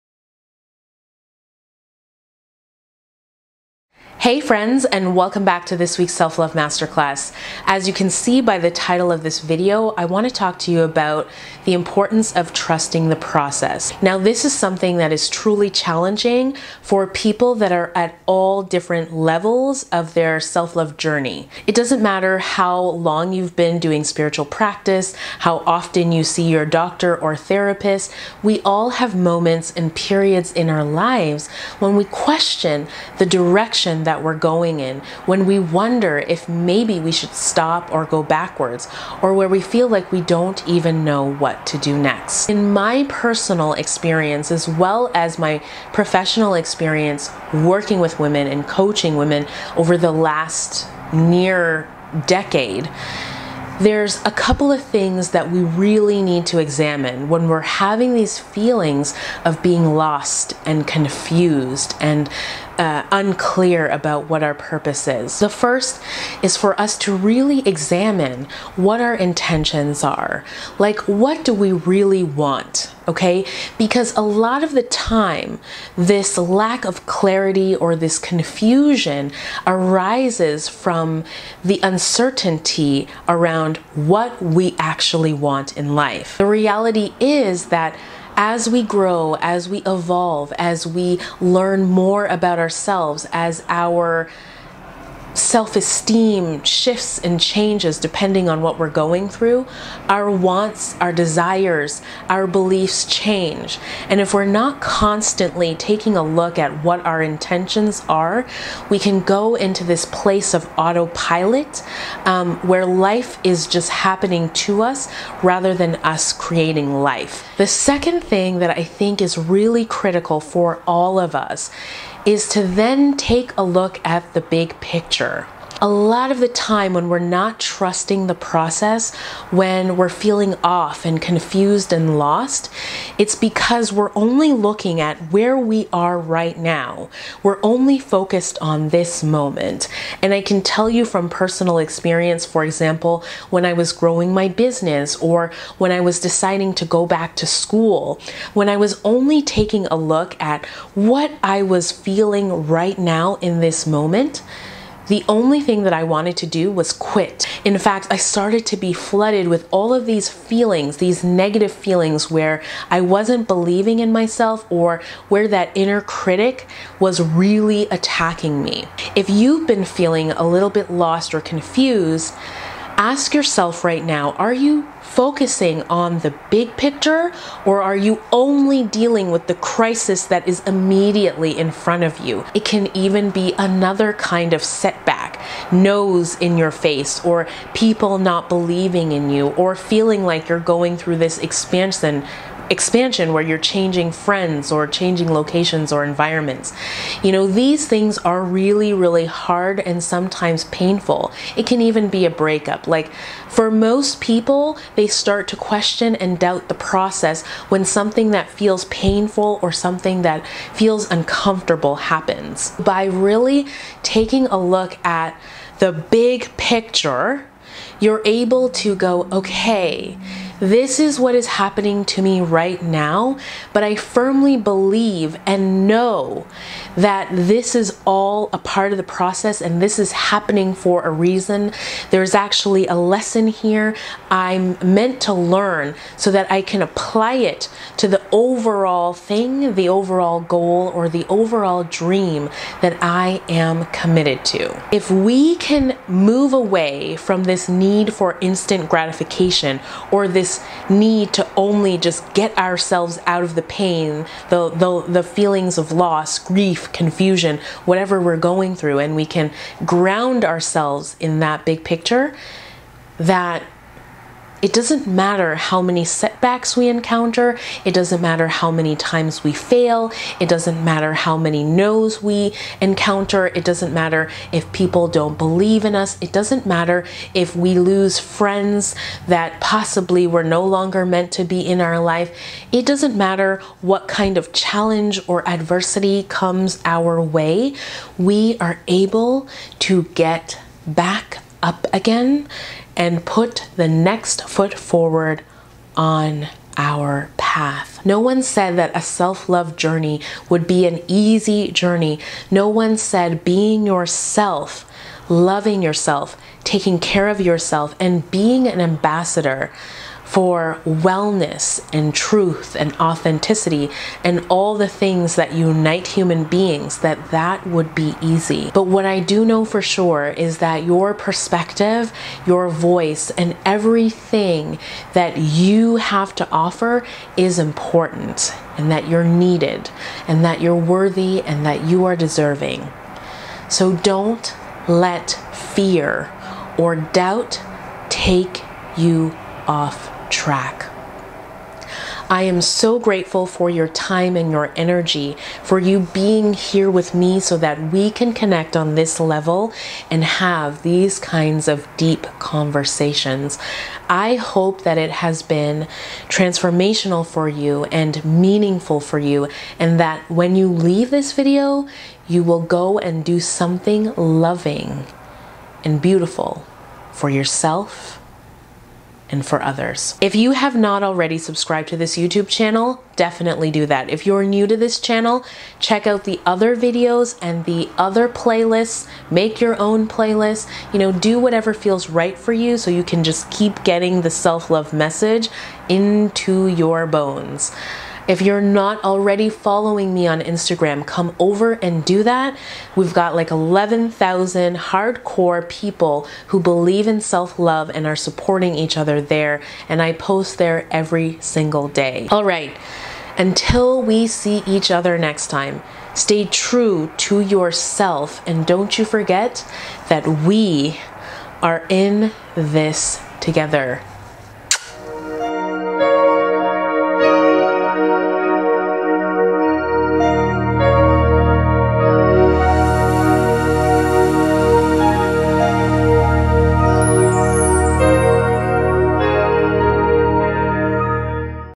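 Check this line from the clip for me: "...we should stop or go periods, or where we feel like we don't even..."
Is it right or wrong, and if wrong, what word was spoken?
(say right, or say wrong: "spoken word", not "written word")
wrong: "backwards", not "periods".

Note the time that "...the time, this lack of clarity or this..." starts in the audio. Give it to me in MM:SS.
01:14.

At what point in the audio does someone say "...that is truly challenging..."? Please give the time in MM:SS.
00:14.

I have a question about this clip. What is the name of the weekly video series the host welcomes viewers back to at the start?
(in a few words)
Self-Love Masterclass.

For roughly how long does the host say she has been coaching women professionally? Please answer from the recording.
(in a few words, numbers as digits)
near decade.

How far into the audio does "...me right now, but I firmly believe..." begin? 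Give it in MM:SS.
03:42.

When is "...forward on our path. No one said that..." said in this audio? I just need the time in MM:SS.
04:54.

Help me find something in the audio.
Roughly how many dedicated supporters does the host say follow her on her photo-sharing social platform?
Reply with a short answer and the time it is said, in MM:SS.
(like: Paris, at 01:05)
11,000, at 06:33.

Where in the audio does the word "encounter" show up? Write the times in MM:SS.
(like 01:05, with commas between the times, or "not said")
04:26, 04:32.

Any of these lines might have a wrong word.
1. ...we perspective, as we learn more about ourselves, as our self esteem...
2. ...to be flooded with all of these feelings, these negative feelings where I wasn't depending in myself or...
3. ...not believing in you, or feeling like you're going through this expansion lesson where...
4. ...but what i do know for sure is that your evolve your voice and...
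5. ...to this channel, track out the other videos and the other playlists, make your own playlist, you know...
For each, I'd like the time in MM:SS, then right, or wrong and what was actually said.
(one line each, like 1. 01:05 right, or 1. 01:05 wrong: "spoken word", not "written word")
1. 01:29 wrong: "evolve", not "perspective"
2. 02:38 wrong: "believing", not "depending"
3. 03:08 wrong: "expansion", not "lesson"
4. 05:18 wrong: "perspective", not "evolve"
5. 06:14 wrong: "check", not "track".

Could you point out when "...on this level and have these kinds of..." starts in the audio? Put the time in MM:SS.
05:48.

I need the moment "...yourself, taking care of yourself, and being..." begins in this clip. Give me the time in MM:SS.
05:05.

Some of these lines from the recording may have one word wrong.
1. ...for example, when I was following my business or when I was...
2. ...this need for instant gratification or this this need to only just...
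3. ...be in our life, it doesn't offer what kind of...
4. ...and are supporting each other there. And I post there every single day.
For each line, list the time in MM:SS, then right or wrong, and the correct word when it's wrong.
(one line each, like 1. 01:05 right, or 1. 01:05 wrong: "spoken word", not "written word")
1. 02:22 wrong: "growing", not "following"
2. 04:07 right
3. 04:41 wrong: "matter", not "offer"
4. 06:37 right.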